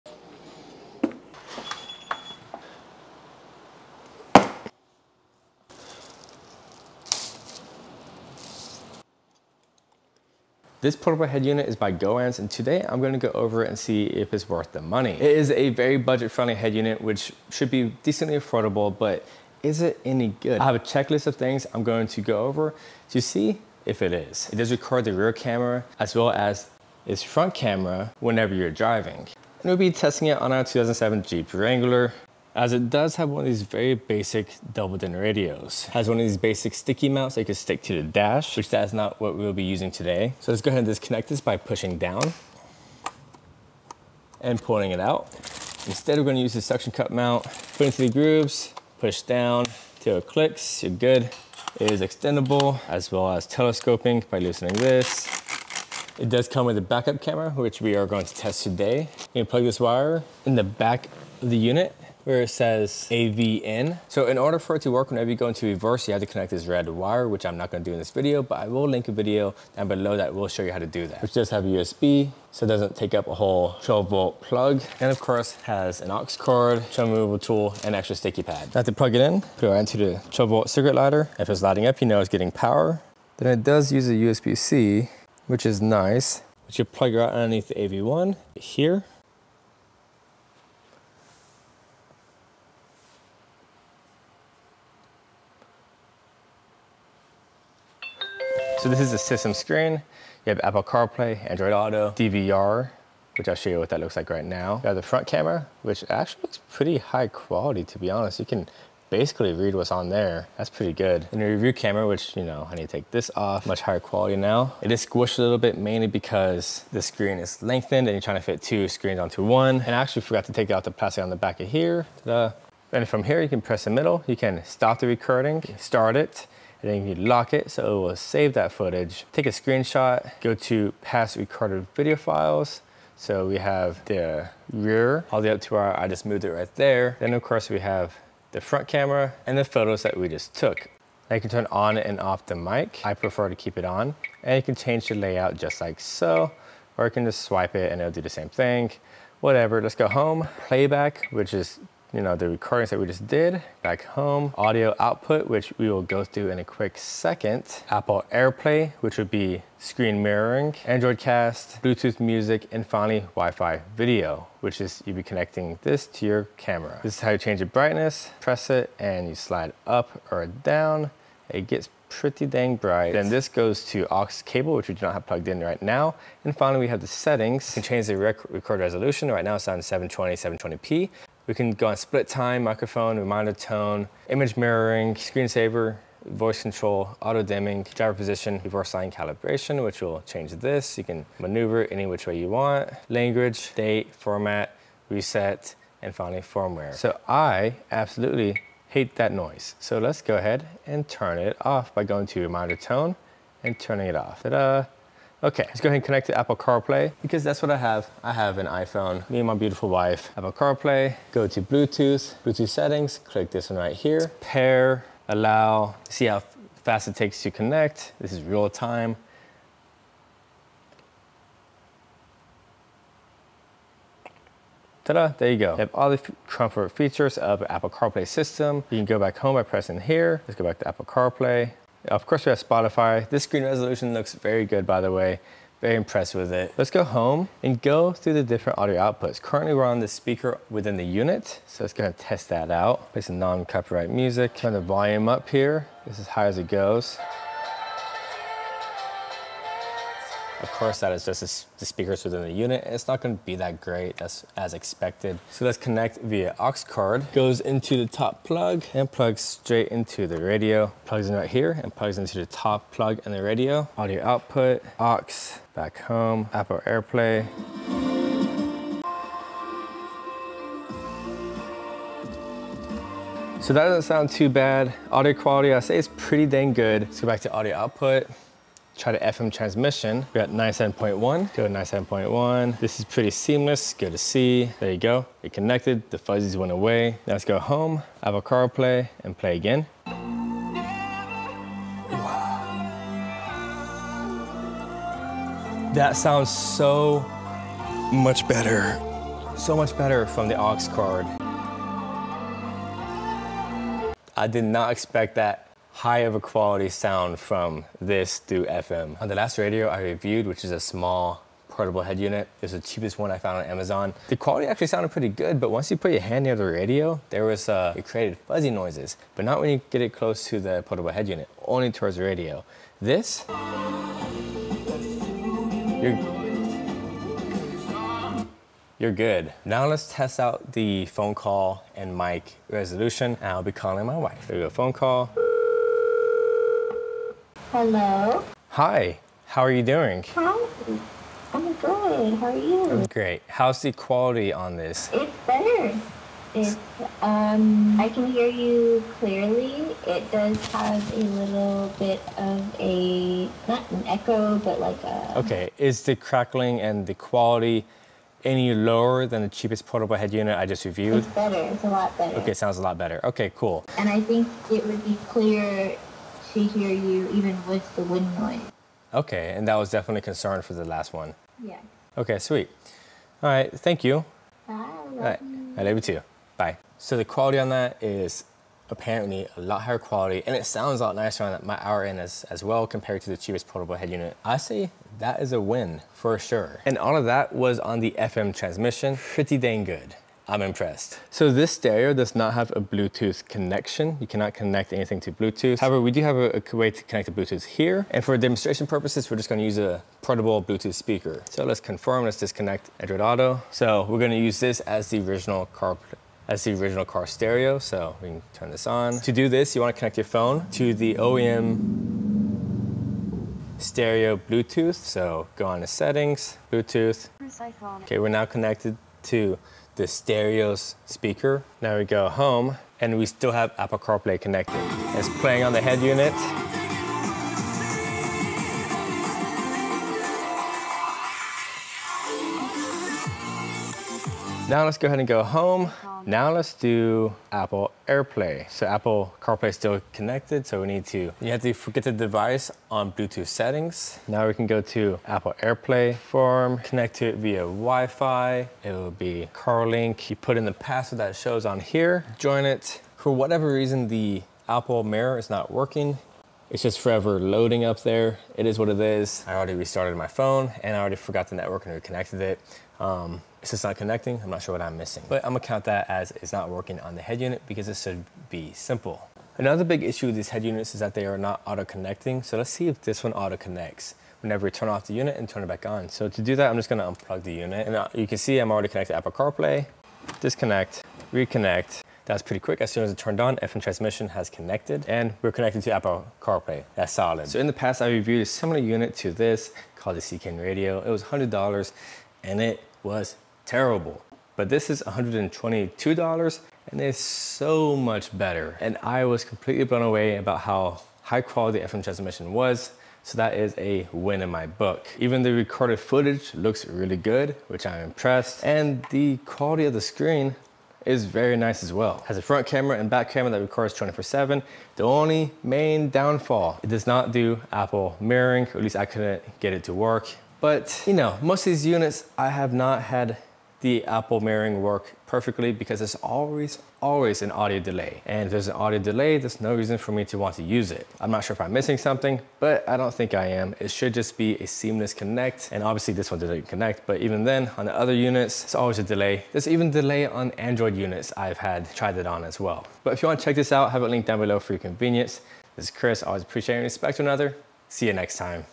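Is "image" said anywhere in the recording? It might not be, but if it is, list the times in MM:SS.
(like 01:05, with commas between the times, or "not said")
03:04.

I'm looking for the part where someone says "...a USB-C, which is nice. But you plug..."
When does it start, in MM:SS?
01:24.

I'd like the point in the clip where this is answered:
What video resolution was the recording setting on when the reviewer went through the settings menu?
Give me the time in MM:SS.
03:00.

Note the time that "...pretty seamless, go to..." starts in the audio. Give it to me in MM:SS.
04:43.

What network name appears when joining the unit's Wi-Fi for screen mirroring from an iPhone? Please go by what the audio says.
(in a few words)
CarLink.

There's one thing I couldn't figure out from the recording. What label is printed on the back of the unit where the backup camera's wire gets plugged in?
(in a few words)
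AVN.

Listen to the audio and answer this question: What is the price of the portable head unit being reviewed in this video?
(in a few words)
$122.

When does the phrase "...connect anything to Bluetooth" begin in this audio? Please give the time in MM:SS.
06:34.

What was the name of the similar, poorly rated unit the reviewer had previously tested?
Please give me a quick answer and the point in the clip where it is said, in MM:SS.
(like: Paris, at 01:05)
CKN Radio, at 08:10.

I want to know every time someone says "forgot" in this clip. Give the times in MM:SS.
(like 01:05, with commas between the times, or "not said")
02:00, 07:41.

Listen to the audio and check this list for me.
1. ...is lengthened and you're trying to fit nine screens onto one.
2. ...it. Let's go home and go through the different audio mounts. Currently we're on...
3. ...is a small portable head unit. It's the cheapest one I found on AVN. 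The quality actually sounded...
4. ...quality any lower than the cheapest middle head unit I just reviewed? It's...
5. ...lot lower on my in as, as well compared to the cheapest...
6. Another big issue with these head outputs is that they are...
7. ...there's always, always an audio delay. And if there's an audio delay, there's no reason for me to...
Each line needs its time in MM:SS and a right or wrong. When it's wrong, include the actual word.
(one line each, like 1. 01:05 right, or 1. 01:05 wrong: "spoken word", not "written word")
1. 01:57 wrong: "two", not "nine"
2. 03:56 wrong: "outputs", not "mounts"
3. 05:10 wrong: "Amazon", not "AVN"
4. 05:57 wrong: "portable", not "middle"
5. 06:21 wrong: "nicer", not "lower"
6. 07:49 wrong: "units", not "outputs"
7. 08:45 right.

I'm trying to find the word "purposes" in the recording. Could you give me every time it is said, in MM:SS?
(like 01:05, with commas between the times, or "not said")
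06:38.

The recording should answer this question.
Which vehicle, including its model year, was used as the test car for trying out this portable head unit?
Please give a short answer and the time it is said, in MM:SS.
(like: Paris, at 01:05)
2007 Jeep Wrangler, at 00:30.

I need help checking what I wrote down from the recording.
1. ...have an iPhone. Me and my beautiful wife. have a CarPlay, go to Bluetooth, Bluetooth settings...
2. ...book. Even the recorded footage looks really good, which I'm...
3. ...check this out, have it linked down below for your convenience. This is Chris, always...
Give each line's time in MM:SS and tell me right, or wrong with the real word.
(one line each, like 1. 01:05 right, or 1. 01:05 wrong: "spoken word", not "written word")
1. 03:28 right
2. 08:24 right
3. 09:03 right.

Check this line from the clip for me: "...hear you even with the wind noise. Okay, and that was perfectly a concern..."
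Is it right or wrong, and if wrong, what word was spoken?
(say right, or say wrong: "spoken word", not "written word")
wrong: "definitely", not "perfectly".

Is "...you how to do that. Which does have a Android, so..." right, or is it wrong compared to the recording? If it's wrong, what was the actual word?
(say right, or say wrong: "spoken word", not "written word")
wrong: "USB", not "Android".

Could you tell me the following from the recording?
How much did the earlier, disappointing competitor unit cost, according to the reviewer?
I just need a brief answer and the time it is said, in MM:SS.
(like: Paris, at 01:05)
$100, at 08:11.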